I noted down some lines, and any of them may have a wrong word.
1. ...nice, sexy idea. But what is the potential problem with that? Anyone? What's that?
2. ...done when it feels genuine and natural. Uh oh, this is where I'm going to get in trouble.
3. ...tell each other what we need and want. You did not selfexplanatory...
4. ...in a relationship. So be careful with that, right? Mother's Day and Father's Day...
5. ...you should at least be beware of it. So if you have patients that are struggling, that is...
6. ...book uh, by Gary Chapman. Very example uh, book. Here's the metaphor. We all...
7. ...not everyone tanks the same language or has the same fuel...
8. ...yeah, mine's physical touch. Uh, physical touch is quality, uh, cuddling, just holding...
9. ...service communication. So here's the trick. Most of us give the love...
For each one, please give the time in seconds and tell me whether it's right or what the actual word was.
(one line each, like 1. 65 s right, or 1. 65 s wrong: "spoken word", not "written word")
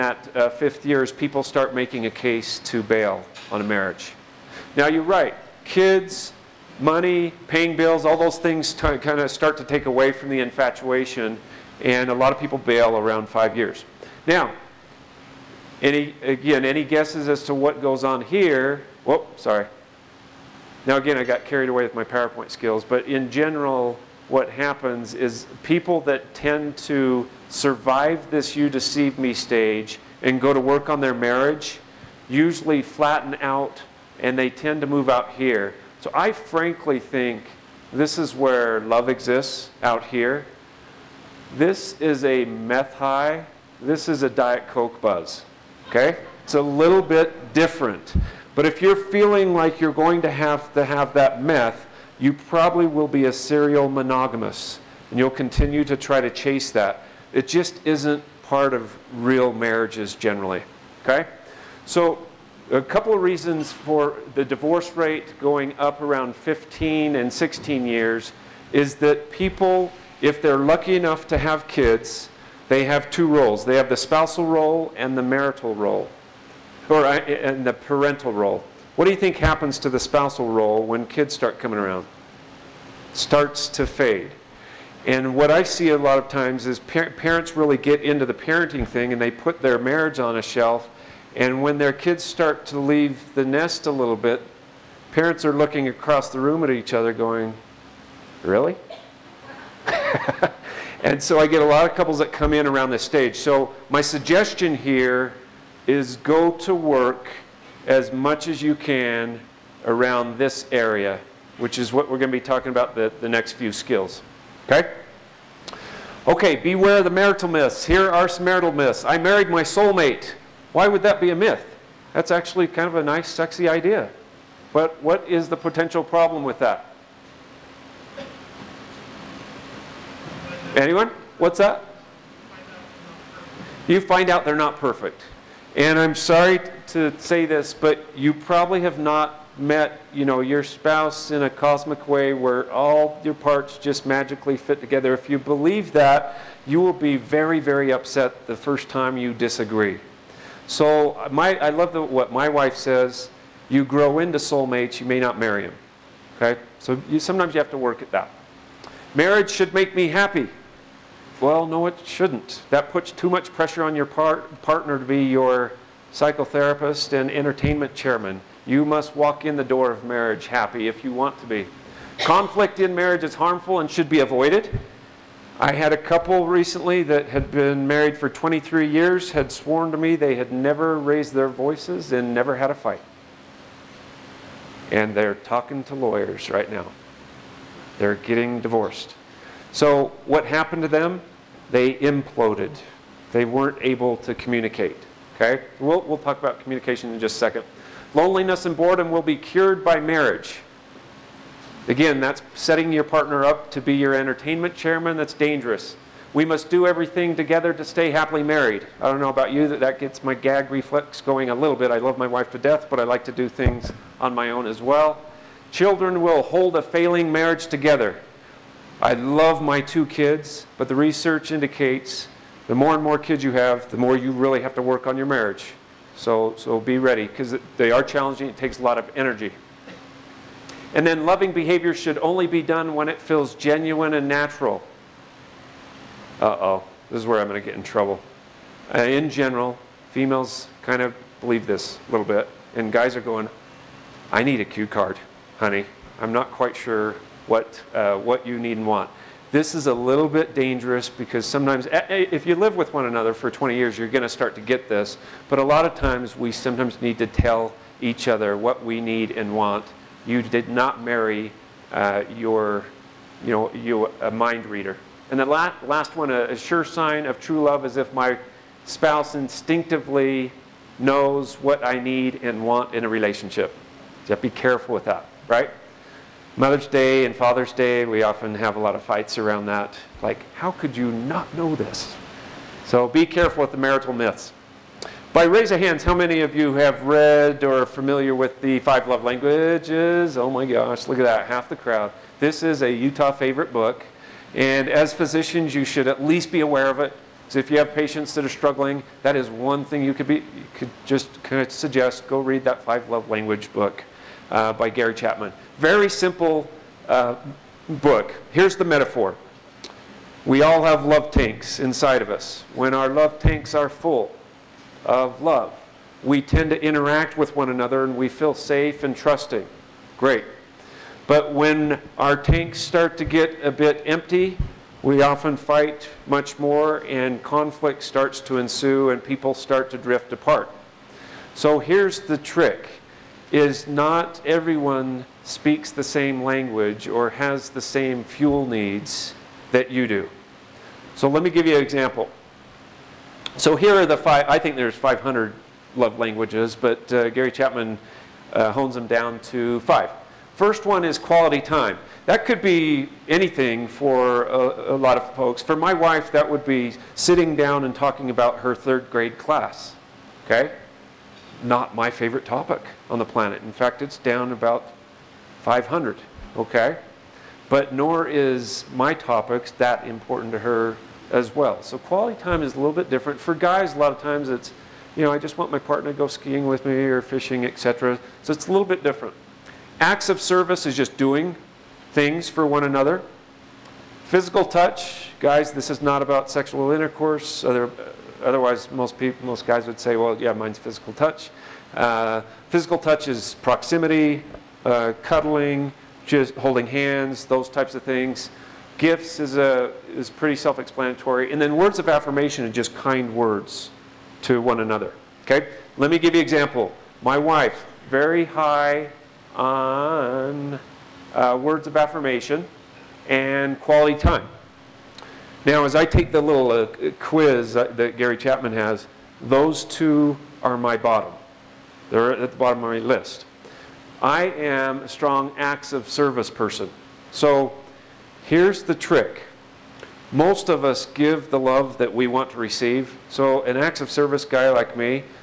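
1. 123 s right
2. 232 s right
3. 257 s wrong: "marry", not "selfexplanatory"
4. 272 s right
5. 295 s wrong: "aware", not "beware"
6. 303 s wrong: "simple", not "example"
7. 333 s wrong: "speaks", not "tanks"
8. 390 s wrong: "proximity", not "quality"
9. 426 s wrong: "person", not "communication".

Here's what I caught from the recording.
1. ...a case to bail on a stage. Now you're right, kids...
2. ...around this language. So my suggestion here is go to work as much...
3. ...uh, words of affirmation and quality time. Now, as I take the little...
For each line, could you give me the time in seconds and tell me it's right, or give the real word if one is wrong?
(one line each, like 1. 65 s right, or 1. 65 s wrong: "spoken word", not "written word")
1. 2 s wrong: "marriage", not "stage"
2. 102 s wrong: "stage", not "language"
3. 411 s right.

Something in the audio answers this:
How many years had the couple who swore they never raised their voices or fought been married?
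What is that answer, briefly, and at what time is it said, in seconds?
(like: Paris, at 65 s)
23, at 178 s.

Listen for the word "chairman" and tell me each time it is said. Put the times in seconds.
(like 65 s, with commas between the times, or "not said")
167 s, 204 s.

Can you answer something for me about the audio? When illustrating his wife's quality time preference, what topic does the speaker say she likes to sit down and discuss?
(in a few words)
Her third grade class.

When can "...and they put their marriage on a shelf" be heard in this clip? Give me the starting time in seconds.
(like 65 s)
89 s.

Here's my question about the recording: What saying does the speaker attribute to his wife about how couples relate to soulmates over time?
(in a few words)
You grow into soulmates.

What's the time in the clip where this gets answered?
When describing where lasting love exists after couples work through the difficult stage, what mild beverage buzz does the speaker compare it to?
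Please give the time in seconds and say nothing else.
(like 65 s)
44 s.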